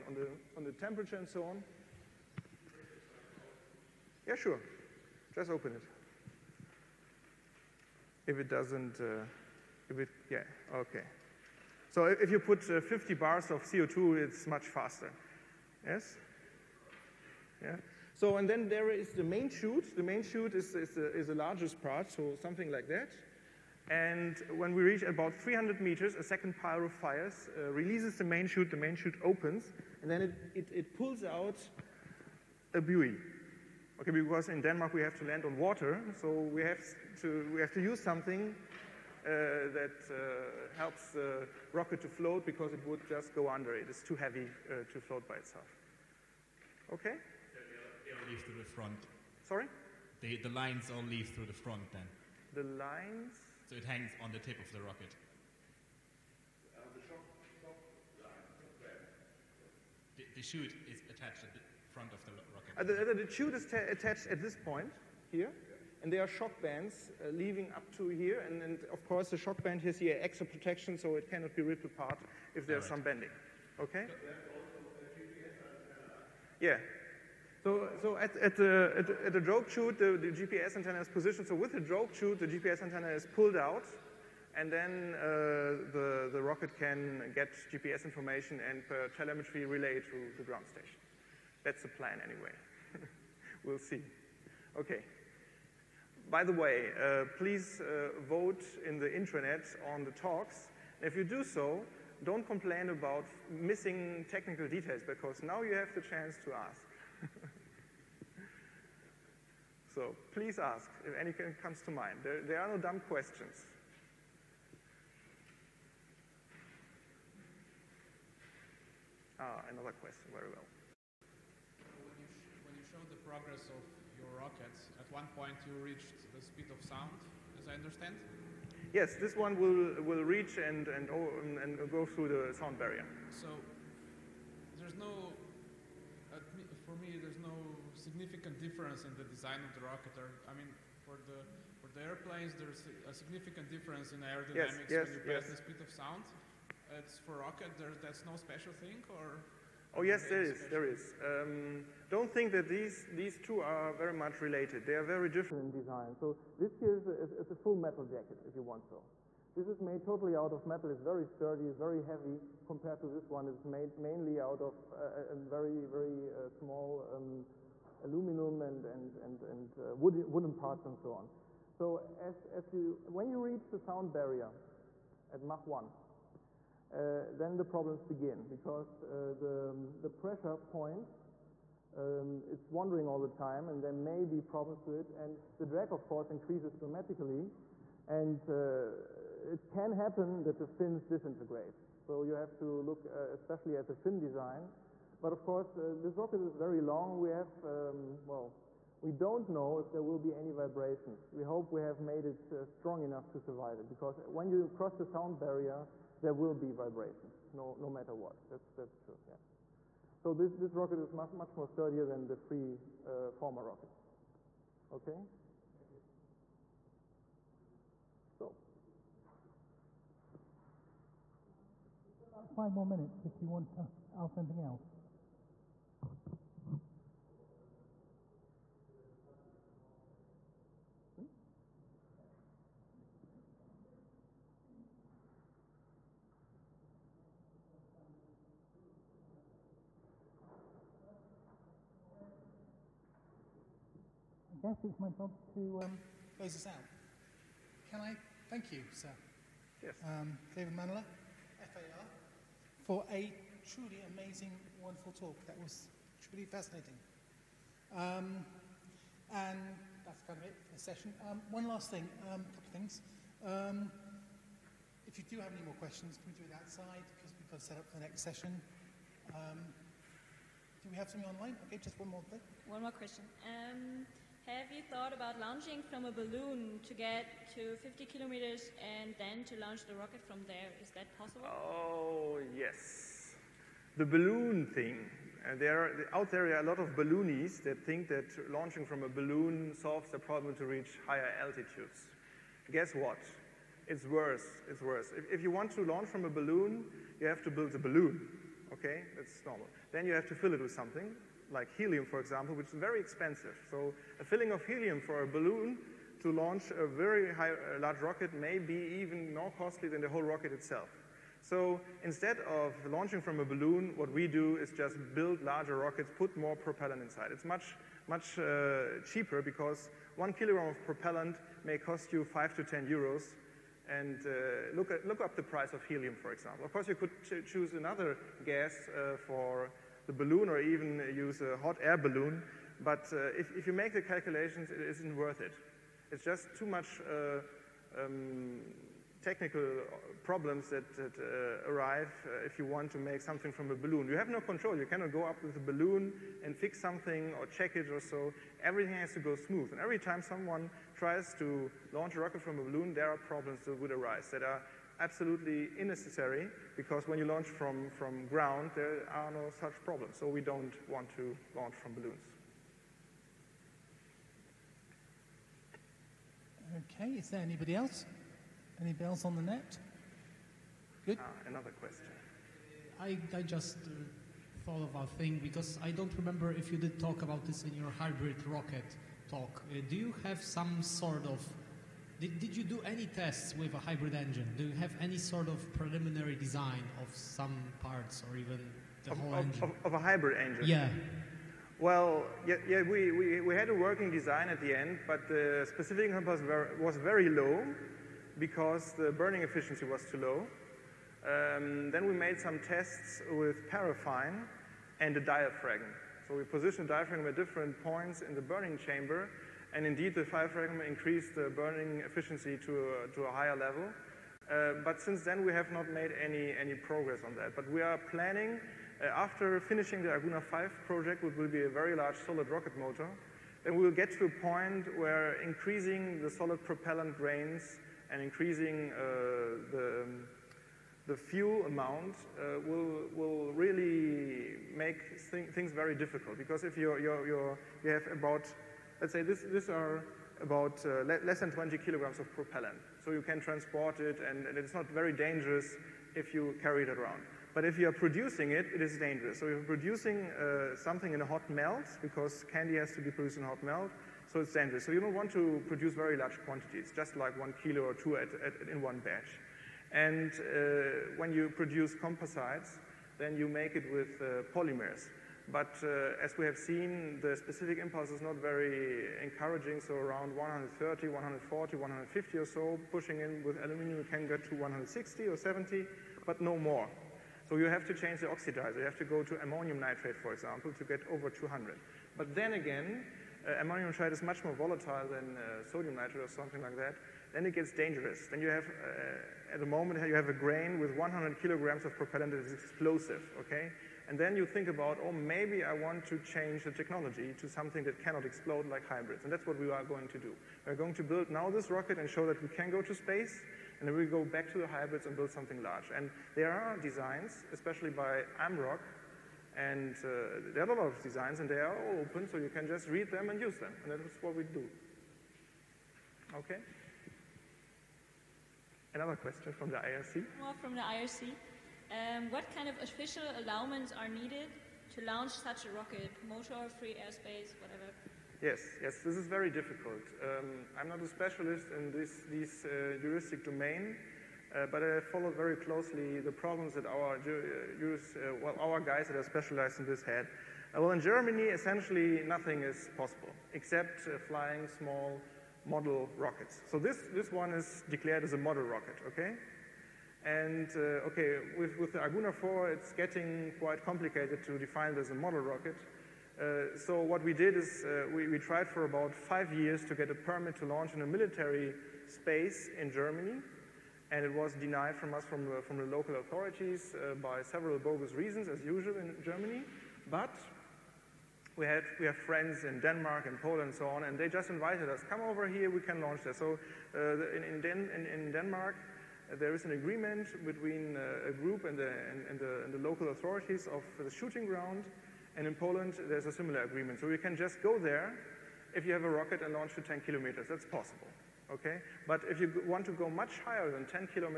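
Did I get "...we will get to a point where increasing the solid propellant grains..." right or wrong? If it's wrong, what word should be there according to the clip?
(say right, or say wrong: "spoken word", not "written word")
right.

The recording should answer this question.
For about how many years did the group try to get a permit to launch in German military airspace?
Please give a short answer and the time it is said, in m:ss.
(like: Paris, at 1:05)
5 years, at 9:19.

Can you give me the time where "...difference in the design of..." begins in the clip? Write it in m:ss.
2:18.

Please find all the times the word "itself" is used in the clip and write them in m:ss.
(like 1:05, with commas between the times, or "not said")
0:45, 5:10.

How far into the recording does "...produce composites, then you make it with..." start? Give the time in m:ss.
7:41.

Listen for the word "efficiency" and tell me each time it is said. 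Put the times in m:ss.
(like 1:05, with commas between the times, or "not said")
6:39, 6:52.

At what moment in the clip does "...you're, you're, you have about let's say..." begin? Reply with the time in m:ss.
7:16.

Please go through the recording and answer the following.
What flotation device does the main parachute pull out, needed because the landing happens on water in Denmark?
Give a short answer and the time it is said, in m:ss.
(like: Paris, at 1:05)
A buoy, at 0:32.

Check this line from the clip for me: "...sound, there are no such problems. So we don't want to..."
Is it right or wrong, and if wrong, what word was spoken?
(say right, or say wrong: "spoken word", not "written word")
wrong: "ground", not "sound".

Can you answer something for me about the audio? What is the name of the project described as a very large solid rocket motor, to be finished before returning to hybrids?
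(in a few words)
Arguna 5.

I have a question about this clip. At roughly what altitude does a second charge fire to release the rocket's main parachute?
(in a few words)
300 meters.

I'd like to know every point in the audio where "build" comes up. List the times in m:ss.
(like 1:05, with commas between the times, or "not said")
4:57, 5:15, 8:21, 8:25.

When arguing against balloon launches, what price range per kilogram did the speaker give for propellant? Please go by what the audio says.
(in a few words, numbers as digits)
5 to 10 euros.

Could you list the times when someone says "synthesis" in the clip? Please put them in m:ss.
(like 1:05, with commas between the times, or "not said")
not said.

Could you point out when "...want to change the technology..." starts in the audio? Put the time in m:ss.
8:15.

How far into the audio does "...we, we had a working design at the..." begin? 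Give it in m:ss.
6:33.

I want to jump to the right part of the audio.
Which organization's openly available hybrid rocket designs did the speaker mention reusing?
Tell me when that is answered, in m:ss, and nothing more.
8:28.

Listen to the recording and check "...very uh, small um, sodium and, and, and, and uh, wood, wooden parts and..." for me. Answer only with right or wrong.
wrong.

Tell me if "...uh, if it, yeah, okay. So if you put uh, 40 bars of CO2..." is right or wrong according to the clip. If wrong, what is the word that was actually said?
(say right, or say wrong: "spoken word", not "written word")
wrong: "50", not "40".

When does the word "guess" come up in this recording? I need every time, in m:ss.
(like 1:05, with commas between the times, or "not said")
4:04, 4:52.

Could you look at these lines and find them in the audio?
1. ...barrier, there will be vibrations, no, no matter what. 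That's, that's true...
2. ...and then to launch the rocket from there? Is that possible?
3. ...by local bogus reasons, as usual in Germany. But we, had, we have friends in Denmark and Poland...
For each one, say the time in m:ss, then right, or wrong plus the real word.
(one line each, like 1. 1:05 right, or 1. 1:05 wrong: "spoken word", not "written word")
1. 3:25 right
2. 4:38 right
3. 9:27 wrong: "several", not "local".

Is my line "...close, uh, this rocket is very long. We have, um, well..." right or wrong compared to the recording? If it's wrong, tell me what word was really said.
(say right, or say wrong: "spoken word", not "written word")
wrong: "course", not "close".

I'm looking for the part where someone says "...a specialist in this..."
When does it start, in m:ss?
8:51.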